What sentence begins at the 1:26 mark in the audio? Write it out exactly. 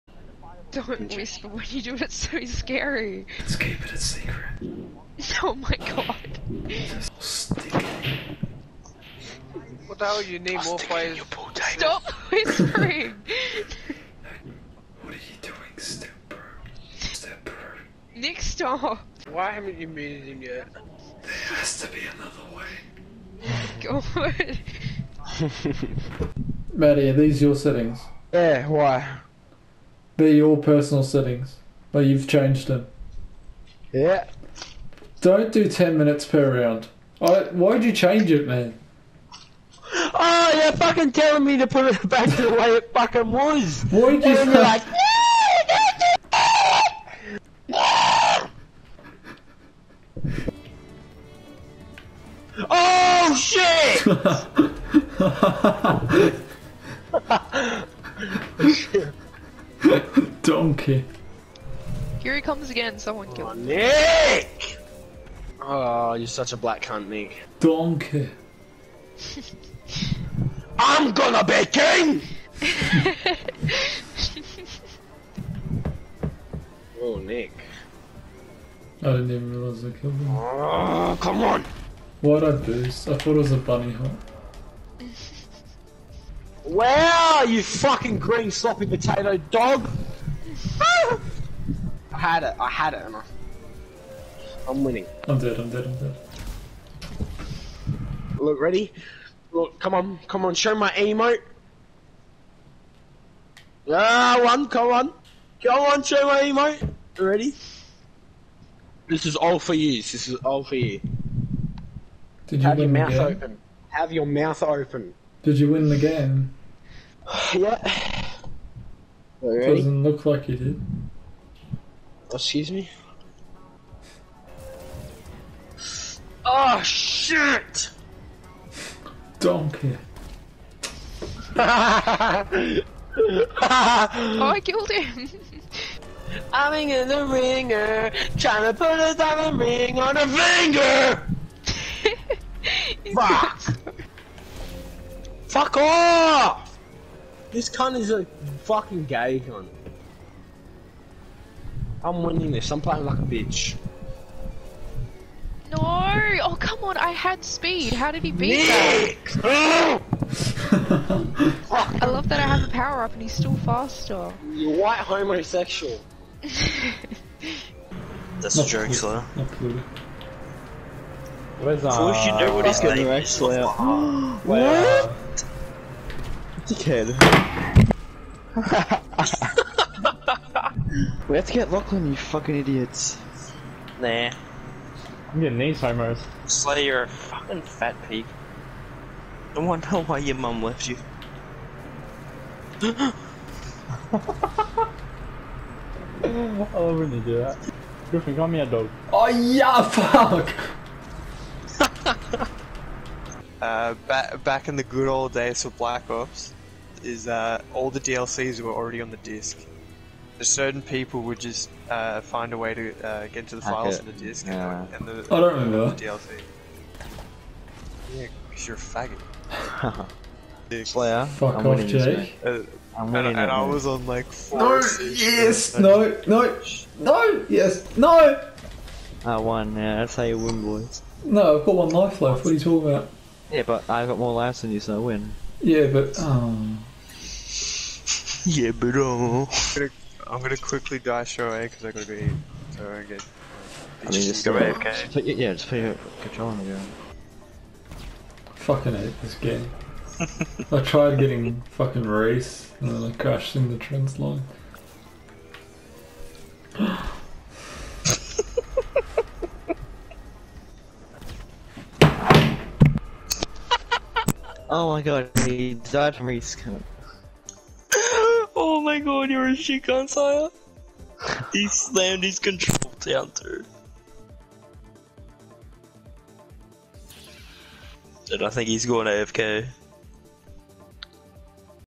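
Wow, you fucking green sloppy potato dog!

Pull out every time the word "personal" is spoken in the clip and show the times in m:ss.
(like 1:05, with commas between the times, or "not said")
0:30.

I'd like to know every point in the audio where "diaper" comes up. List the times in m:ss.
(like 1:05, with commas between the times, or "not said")
not said.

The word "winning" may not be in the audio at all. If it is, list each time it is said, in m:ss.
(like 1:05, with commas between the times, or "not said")
1:34, 2:32.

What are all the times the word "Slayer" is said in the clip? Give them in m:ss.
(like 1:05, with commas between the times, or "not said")
2:48, 3:06, 3:40.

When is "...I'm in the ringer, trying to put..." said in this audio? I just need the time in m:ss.
2:16.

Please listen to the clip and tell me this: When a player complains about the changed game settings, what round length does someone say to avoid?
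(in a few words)
10 minutes.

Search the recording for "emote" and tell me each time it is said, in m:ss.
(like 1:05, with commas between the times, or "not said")
1:40, 1:46.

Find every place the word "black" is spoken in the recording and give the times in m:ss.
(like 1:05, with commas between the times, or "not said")
1:06, 3:25.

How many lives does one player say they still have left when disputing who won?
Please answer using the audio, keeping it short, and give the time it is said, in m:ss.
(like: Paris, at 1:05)
1, at 3:51.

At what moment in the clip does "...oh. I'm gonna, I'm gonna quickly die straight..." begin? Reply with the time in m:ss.
3:58.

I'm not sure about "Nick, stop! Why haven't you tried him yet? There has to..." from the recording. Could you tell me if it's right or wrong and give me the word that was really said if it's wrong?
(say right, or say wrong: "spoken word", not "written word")
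wrong: "muted", not "tried".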